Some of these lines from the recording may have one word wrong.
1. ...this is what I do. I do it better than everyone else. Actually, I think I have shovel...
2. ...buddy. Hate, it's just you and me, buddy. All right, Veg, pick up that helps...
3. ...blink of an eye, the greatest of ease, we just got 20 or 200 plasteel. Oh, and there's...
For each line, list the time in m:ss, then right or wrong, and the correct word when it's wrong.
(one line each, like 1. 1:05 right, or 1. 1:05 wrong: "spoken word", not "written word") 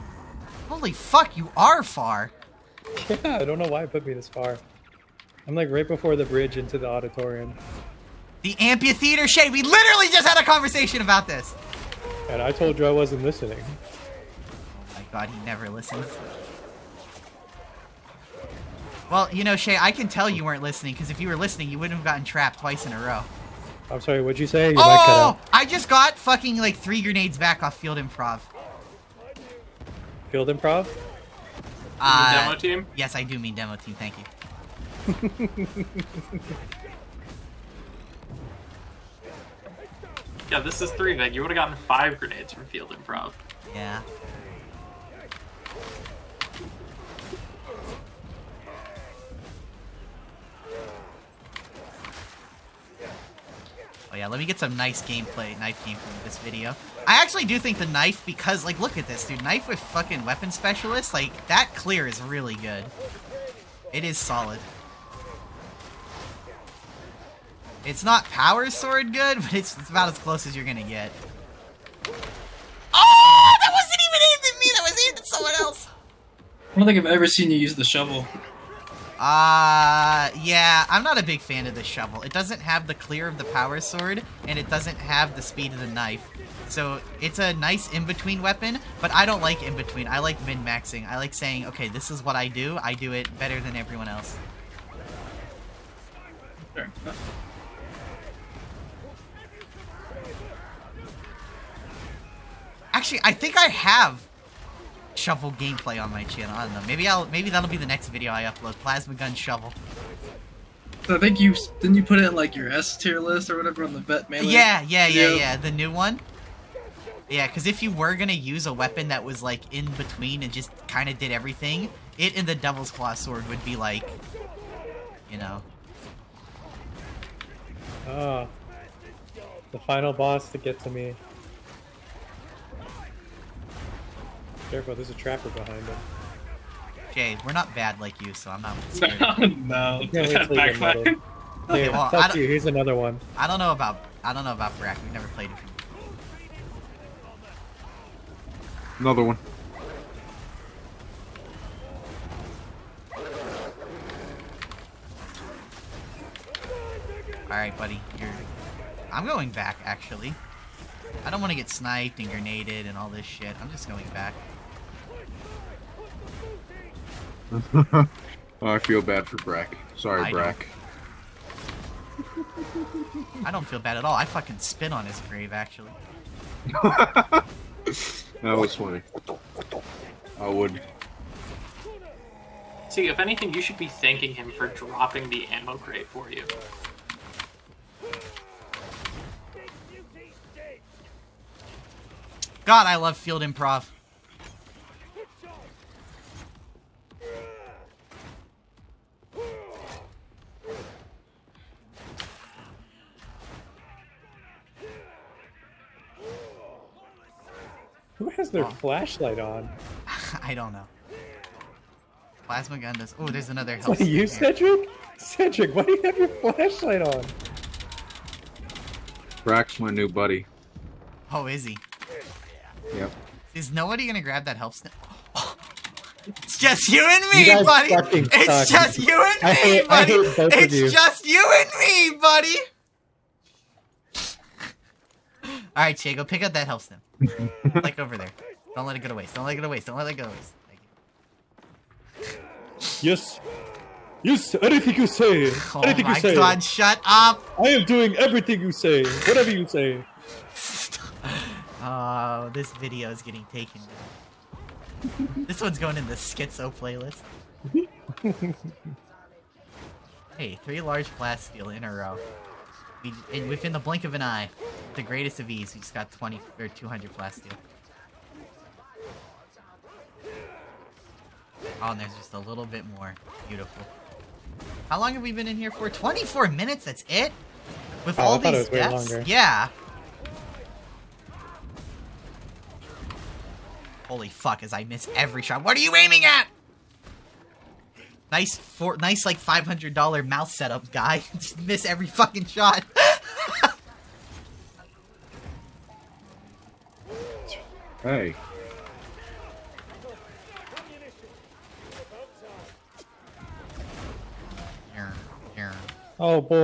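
1. 1:31 right
2. 3:49 wrong: "Shay", not "Veg"
3. 4:23 right.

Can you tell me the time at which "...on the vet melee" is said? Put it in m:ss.
1:53.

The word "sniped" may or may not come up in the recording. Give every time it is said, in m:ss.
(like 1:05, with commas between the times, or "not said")
2:41.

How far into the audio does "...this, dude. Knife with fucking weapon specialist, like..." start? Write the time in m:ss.
0:59.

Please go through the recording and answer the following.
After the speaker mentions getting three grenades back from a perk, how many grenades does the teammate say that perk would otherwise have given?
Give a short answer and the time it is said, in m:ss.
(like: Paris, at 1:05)
5, at 0:41.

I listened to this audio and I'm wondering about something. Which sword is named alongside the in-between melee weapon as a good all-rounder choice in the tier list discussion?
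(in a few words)
Devil's Claw.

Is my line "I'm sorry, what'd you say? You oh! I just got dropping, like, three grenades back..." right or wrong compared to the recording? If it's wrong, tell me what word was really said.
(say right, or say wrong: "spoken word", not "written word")
wrong: "fucking", not "dropping".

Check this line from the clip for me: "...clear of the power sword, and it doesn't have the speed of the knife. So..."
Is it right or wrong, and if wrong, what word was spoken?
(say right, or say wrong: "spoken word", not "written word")
right.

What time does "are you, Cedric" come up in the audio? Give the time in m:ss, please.
3:33.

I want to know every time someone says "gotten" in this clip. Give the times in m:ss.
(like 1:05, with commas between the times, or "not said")
0:22, 0:41.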